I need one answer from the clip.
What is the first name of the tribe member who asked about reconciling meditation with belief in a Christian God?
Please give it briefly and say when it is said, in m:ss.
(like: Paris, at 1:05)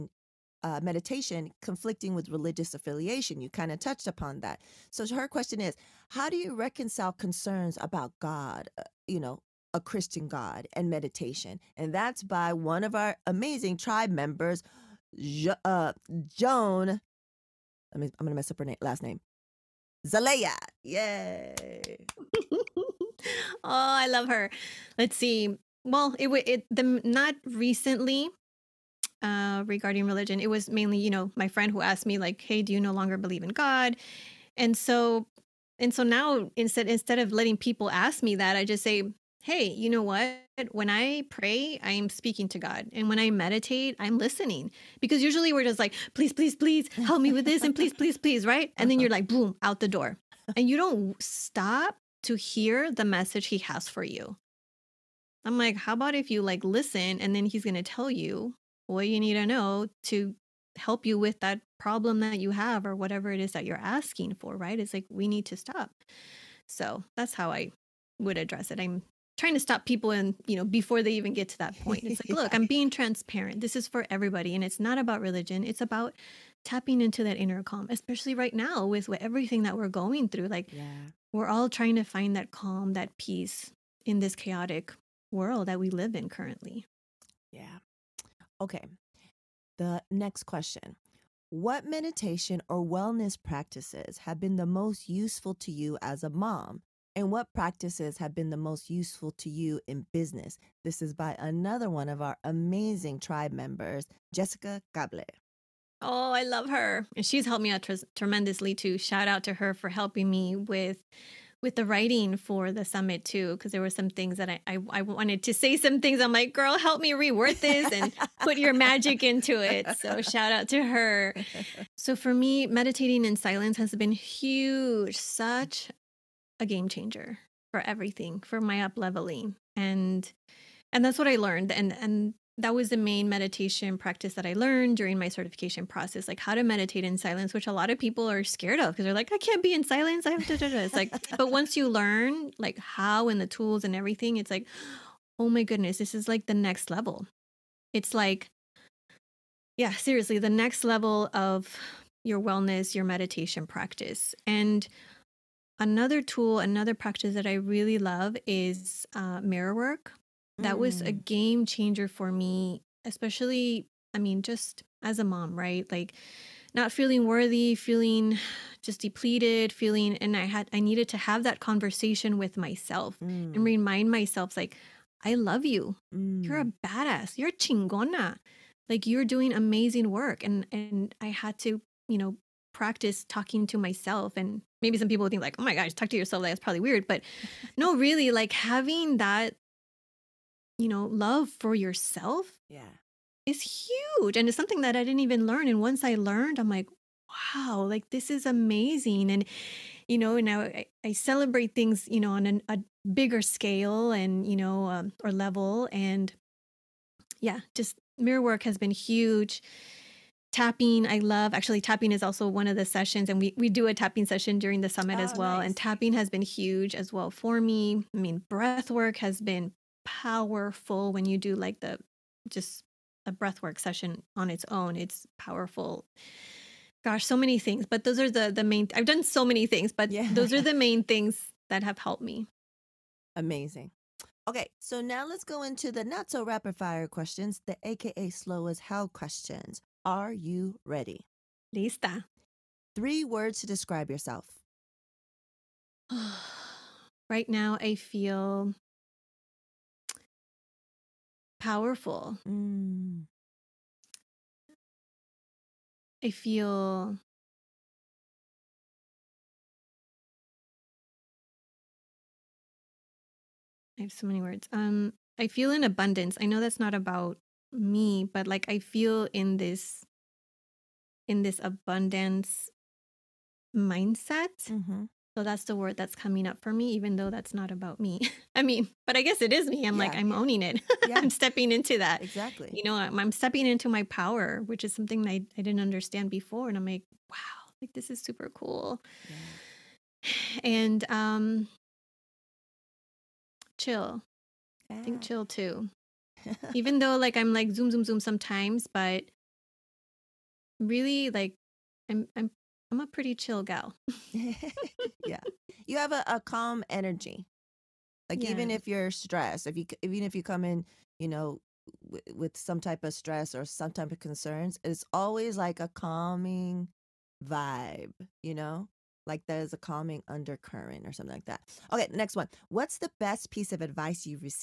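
Joan, at 0:16.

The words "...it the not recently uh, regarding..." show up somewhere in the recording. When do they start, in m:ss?
0:26.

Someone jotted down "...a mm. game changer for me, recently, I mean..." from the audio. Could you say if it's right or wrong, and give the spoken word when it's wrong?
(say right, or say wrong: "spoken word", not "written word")
wrong: "especially", not "recently".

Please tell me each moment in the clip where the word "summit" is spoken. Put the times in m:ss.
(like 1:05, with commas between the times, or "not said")
1:52, 3:34.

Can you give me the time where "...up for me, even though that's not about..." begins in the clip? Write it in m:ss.
4:36.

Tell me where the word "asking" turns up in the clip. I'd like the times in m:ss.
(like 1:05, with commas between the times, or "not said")
1:03.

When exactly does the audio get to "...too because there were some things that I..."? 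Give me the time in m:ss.
1:53.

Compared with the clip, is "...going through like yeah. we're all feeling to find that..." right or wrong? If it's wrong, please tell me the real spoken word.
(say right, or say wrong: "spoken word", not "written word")
wrong: "trying", not "feeling".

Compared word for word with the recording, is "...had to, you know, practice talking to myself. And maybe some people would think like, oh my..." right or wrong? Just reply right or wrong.
right.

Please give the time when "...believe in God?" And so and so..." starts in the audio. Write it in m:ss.
0:33.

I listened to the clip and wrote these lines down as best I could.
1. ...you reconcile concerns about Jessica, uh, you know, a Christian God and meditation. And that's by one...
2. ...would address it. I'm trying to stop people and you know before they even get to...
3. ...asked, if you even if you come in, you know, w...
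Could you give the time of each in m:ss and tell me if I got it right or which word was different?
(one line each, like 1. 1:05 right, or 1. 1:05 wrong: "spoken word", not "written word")
1. 0:06 wrong: "God", not "Jessica"
2. 1:08 right
3. 5:09 wrong: "stressed", not "asked".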